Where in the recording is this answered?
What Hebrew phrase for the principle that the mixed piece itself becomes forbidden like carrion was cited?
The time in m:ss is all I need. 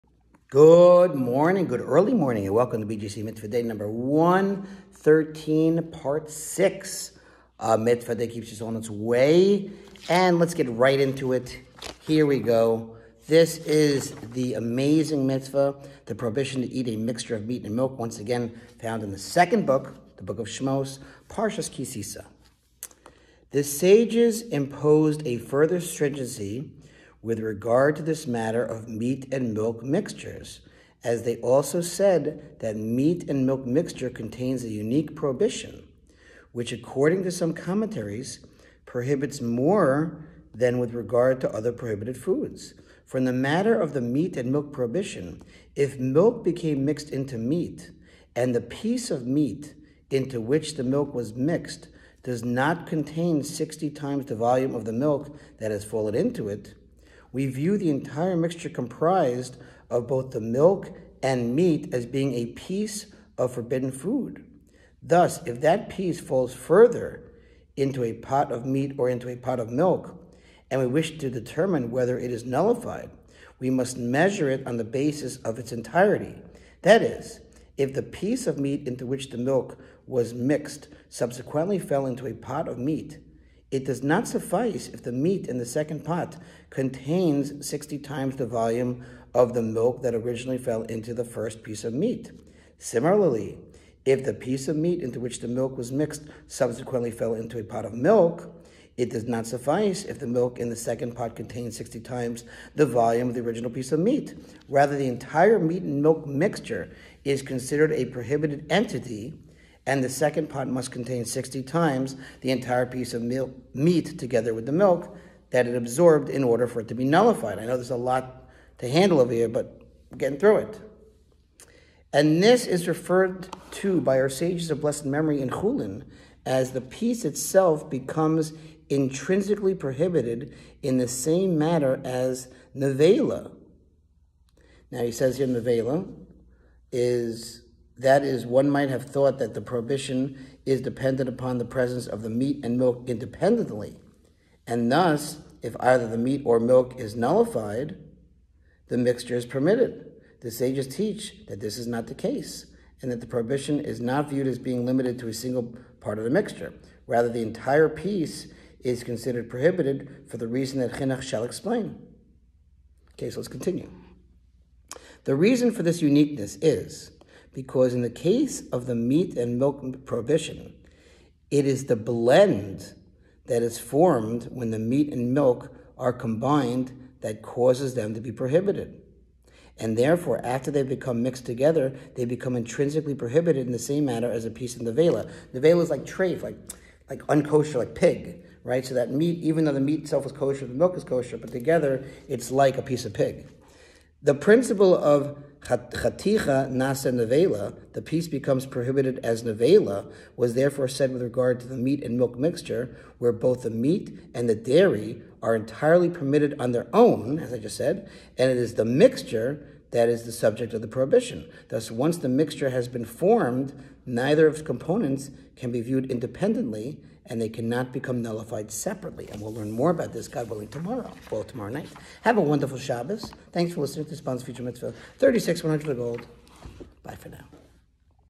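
3:15.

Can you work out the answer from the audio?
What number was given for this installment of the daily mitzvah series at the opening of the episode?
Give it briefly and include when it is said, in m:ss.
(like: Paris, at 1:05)
113, at 0:03.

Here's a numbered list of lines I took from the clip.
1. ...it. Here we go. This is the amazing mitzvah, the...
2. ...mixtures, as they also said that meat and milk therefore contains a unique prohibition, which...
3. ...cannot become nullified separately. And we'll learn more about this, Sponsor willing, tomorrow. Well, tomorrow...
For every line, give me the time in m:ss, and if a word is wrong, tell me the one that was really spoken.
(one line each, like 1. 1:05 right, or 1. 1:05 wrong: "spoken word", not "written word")
1. 0:11 right
2. 0:29 wrong: "mixture", not "therefore"
3. 3:37 wrong: "God", not "Sponsor".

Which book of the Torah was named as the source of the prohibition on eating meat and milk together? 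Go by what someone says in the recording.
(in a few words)
Shmos.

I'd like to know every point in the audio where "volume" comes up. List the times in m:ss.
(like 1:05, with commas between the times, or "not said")
0:54, 1:28, 1:42.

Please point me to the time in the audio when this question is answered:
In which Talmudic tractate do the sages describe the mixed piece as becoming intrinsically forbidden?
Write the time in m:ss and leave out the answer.
2:05.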